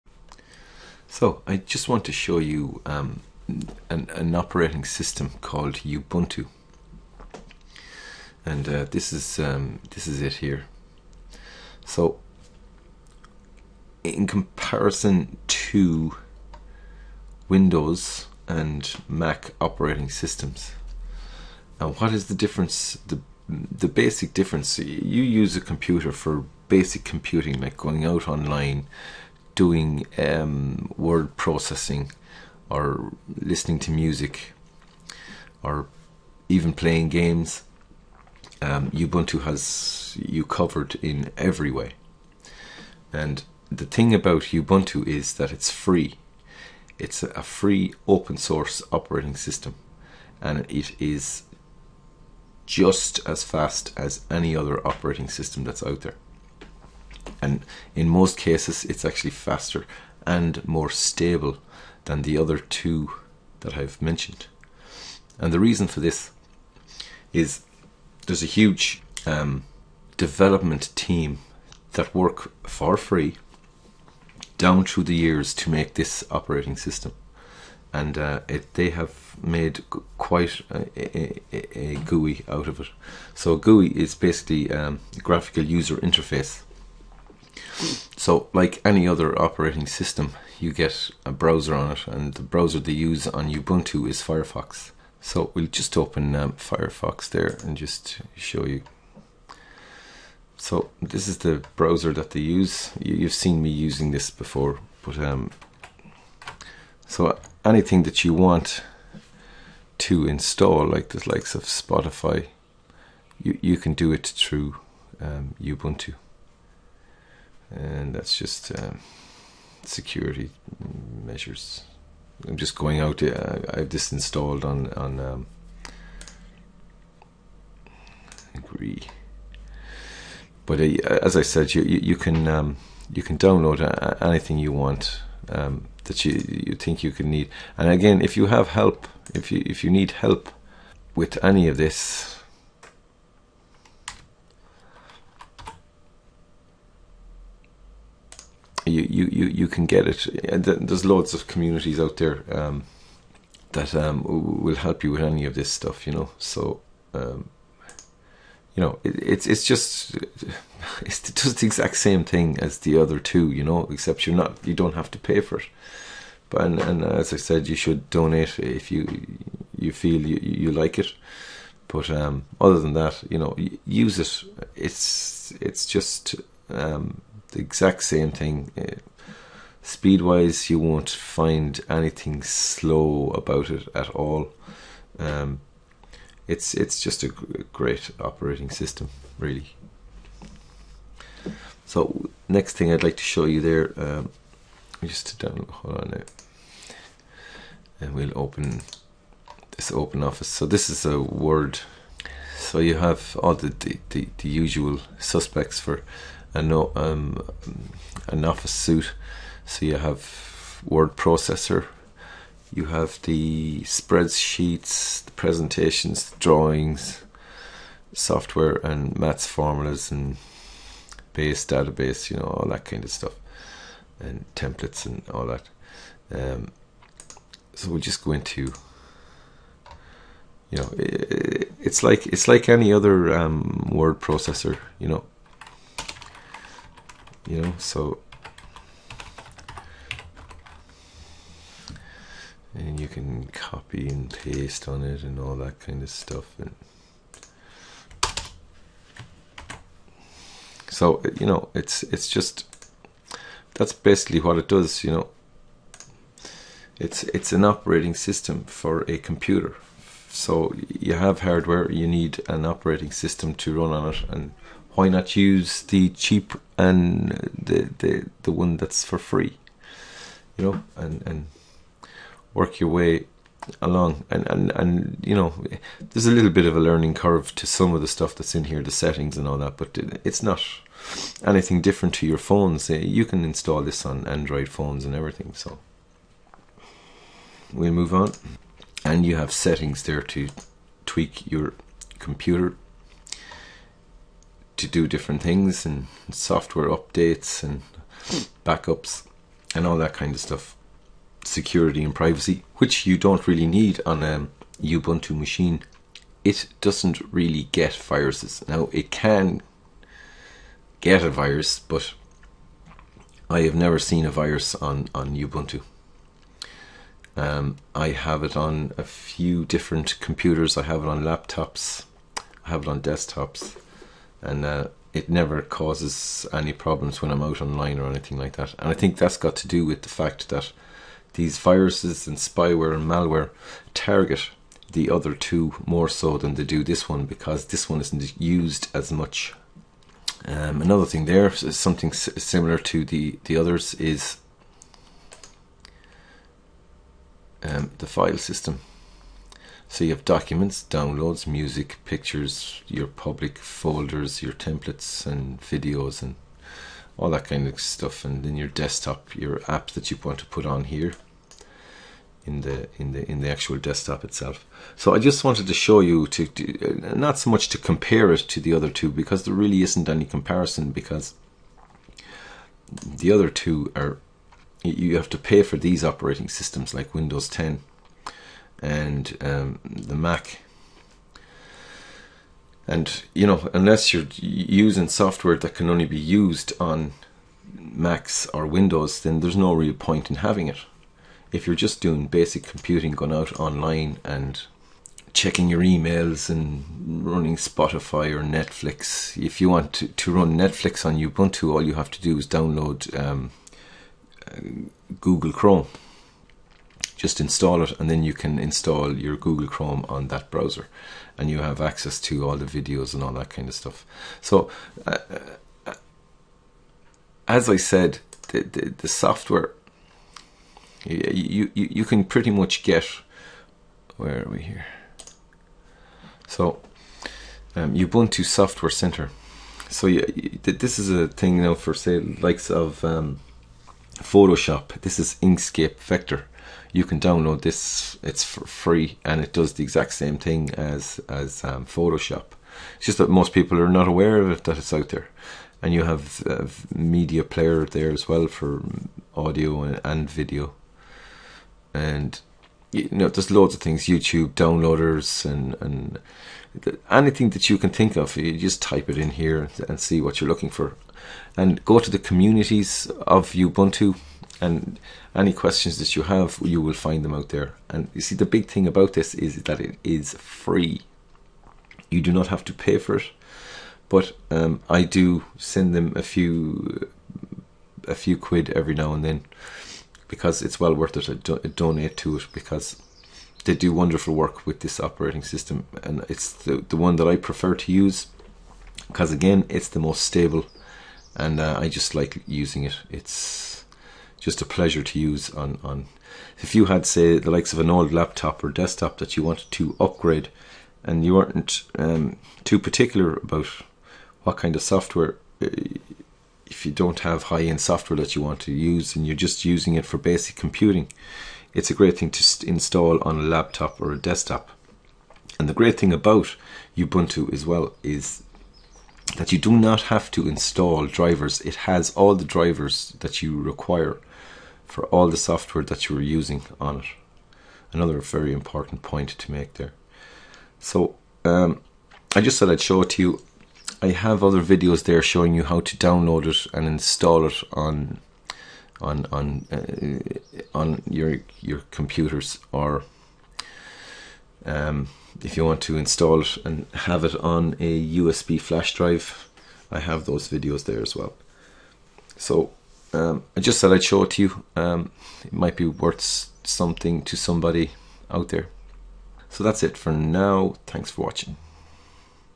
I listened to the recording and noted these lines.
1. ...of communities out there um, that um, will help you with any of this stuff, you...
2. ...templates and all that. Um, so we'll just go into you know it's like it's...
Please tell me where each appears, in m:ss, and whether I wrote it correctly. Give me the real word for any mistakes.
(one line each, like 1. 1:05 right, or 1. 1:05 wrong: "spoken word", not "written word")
1. 2:31 right
2. 3:44 right.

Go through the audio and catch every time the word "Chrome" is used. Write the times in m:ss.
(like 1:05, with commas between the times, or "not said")
6:45, 6:49.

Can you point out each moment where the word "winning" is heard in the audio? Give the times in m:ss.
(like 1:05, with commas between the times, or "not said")
not said.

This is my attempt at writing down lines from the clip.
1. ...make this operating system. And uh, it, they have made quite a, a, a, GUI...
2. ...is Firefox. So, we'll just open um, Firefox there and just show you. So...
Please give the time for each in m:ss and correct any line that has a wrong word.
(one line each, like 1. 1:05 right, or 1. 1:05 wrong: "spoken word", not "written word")
1. 1:15 right
2. 1:34 right.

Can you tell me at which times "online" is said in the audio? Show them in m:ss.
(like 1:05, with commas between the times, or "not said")
0:28, 5:27, 6:33.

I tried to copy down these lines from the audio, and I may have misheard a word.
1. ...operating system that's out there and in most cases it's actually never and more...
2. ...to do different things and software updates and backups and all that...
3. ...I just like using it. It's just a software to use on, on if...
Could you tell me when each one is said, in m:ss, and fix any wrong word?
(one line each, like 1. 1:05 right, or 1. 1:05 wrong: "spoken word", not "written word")
1. 0:54 wrong: "faster", not "never"
2. 4:54 right
3. 8:11 wrong: "pleasure", not "software".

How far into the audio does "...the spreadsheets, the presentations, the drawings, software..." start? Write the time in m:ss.
3:33.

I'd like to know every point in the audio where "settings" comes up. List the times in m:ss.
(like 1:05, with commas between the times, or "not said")
4:38, 4:49.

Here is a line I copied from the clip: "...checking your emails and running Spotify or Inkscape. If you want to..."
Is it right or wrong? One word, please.
wrong.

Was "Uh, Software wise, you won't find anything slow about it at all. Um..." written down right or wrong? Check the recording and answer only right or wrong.
wrong.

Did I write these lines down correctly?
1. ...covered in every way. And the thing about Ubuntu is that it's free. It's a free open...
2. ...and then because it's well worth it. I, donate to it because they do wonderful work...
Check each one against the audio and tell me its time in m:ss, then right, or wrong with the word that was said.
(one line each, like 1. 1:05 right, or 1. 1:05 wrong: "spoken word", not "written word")
1. 0:40 right
2. 7:59 right.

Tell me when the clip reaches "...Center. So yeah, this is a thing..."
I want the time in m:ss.
7:08.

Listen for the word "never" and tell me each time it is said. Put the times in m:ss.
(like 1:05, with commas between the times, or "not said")
5:13, 5:25.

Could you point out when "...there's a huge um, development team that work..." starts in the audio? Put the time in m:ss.
1:08.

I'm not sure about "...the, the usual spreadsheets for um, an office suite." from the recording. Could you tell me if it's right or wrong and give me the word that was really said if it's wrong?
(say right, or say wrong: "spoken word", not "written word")
wrong: "suspects", not "spreadsheets".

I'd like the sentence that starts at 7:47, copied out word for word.
And you see, the big thing about this is that it is free.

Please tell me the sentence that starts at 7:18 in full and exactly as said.
It's free and it does the exact same thing as as um, Photoshop.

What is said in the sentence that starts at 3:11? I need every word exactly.
So next thing I'd like to show you there, um, just to download.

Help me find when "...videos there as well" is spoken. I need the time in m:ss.
9:10.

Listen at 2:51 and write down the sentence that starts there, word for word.
But um, other than that, you know, use it.